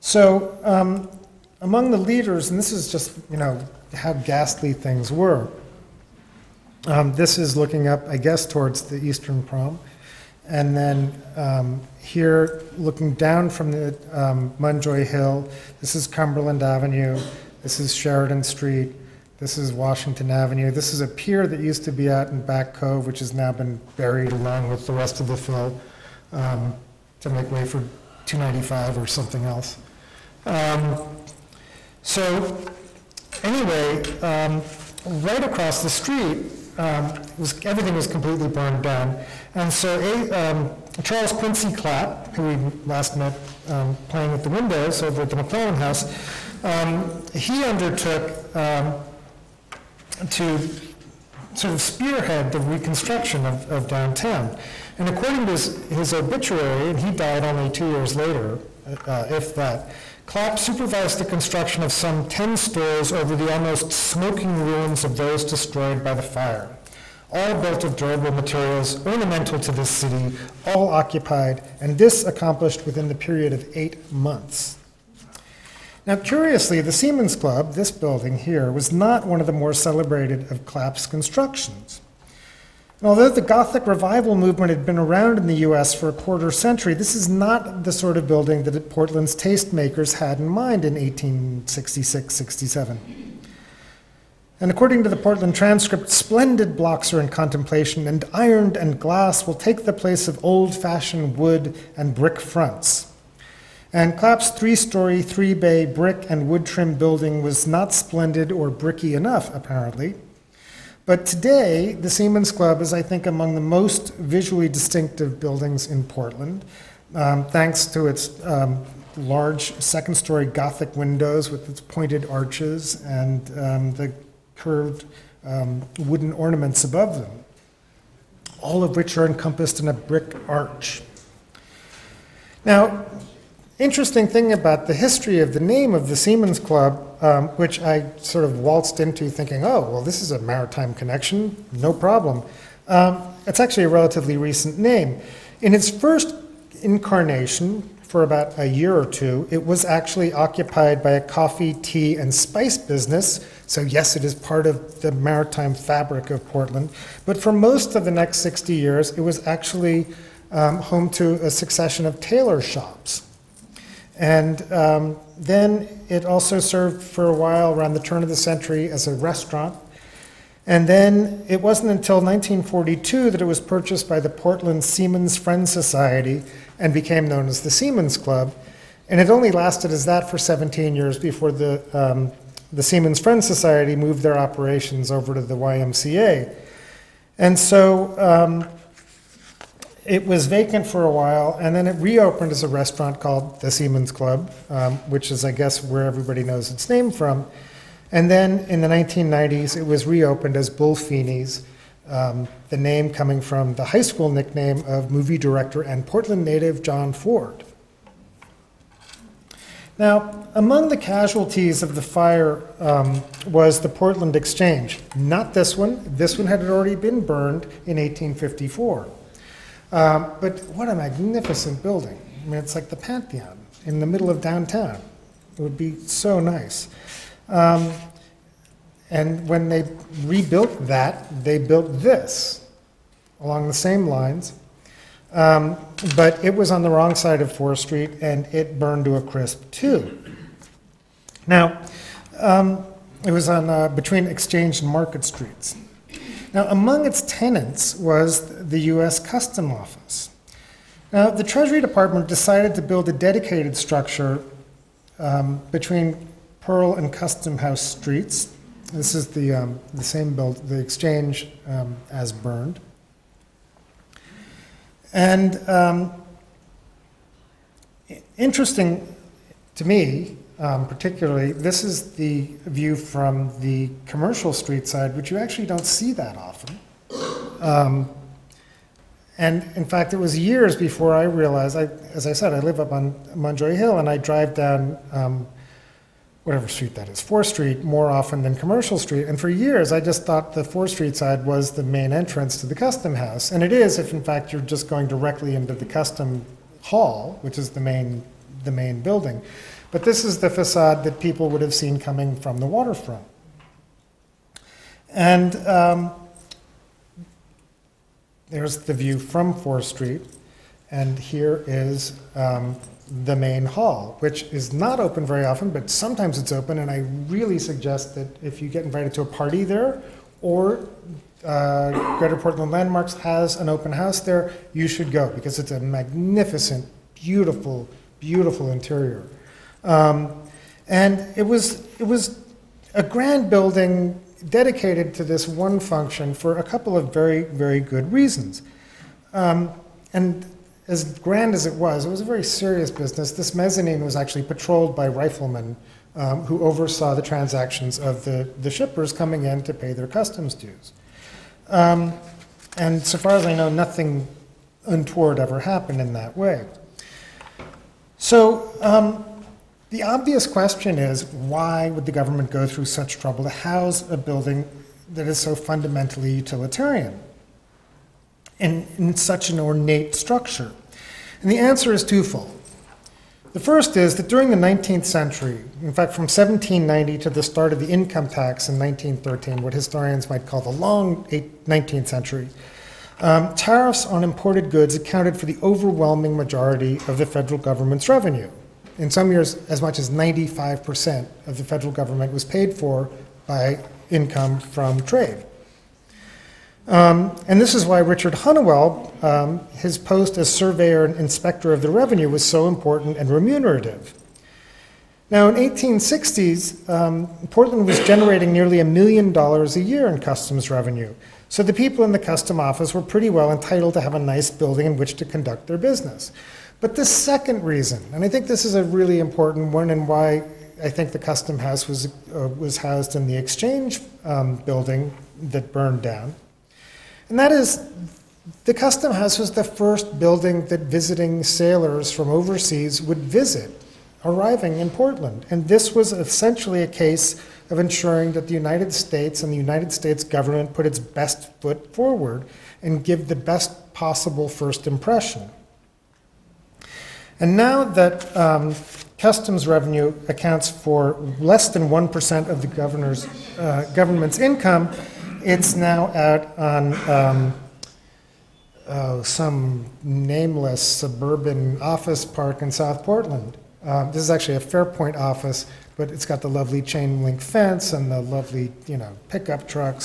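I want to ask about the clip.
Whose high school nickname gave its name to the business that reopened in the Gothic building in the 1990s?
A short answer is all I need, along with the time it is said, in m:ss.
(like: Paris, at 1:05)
John Ford, at 3:26.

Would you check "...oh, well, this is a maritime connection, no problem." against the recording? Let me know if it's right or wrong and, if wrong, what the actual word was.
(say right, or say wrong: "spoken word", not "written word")
right.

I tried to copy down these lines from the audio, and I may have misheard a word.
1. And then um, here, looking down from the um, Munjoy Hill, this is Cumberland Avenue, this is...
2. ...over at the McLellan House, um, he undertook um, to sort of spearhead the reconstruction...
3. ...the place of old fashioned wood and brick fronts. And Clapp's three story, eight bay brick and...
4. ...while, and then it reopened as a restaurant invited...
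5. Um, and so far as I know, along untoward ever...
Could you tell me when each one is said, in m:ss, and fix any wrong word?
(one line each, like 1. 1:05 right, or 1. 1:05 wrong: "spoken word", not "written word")
1. 0:10 right
2. 0:45 right
3. 1:39 wrong: "three", not "eight"
4. 3:11 wrong: "called", not "invited"
5. 5:51 wrong: "nothing", not "along".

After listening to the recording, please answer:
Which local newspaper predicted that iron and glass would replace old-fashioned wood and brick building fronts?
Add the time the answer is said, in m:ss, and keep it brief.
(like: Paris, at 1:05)
Portland Transcript, at 1:35.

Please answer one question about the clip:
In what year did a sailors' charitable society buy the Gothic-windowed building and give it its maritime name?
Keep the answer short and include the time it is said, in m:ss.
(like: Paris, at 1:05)
1942, at 2:52.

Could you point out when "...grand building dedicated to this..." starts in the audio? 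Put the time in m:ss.
5:33.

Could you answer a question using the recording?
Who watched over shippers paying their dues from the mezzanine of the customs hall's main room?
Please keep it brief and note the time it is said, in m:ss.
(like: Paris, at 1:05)
Riflemen, at 5:45.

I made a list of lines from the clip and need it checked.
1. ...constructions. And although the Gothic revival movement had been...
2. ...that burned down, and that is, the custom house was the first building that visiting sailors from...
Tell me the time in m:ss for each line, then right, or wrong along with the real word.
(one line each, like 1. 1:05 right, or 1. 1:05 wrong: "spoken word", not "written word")
1. 1:21 right
2. 7:05 right.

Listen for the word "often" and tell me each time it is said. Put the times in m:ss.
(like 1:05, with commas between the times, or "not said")
4:36, 4:48, 5:15.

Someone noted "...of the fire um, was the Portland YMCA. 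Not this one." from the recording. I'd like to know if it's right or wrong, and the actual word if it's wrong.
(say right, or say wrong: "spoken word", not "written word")
wrong: "Exchange", not "YMCA".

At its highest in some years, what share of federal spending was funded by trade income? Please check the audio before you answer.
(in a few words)
95%.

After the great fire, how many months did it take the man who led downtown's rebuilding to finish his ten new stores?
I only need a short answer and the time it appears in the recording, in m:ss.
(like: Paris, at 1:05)
8, at 1:13.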